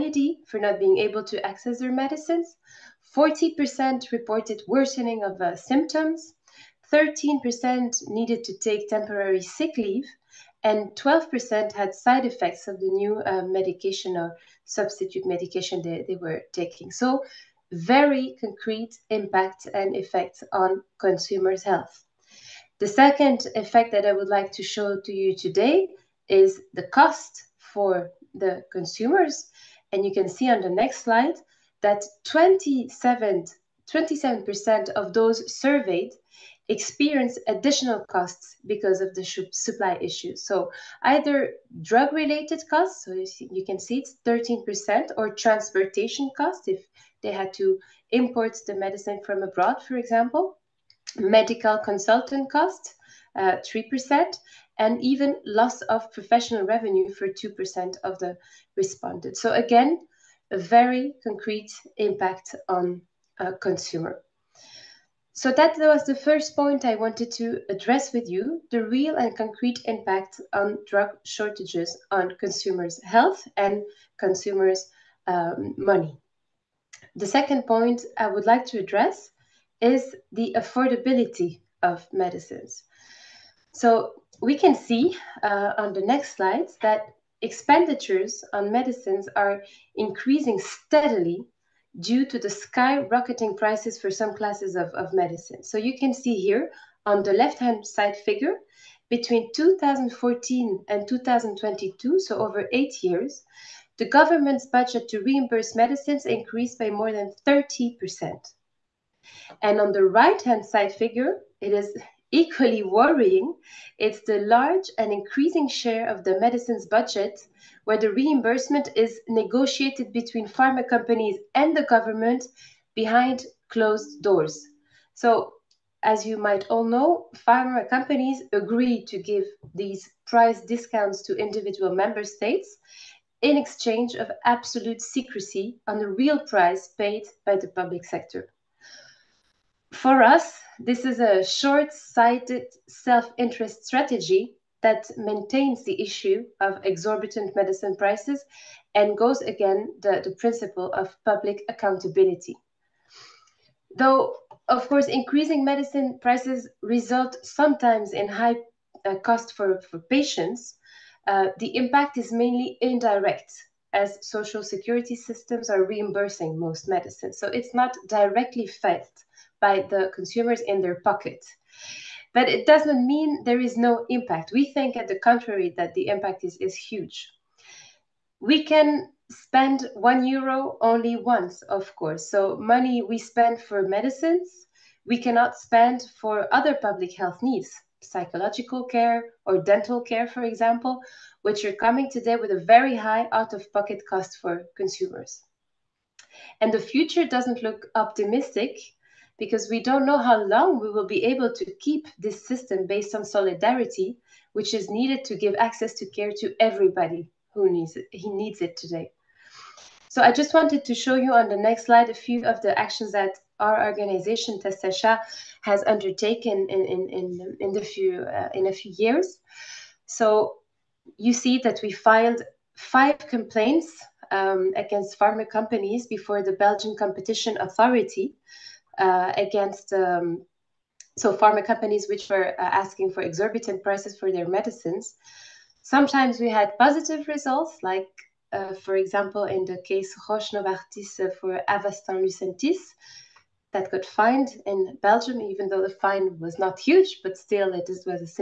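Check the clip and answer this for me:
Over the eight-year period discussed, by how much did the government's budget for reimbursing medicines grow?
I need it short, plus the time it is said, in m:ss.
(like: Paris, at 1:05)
more than 30%, at 1:46.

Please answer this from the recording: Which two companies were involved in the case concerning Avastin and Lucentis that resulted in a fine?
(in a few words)
Roche Novartis.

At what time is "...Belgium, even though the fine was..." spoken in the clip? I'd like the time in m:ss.
4:05.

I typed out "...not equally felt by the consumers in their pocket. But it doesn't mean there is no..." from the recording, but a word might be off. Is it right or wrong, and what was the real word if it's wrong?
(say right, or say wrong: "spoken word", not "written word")
wrong: "directly", not "equally".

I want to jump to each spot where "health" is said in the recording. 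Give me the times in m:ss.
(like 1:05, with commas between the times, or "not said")
0:21, 1:13, 3:07.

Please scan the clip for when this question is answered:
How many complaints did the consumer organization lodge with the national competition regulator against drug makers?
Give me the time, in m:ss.
3:42.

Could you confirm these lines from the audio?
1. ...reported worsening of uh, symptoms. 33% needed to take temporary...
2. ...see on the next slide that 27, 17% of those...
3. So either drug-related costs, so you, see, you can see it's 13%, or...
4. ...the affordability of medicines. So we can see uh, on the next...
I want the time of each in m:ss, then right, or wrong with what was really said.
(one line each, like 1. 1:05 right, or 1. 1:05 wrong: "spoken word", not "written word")
1. 0:04 wrong: "13", not "33"
2. 0:30 wrong: "27", not "17"
3. 0:40 right
4. 1:20 right.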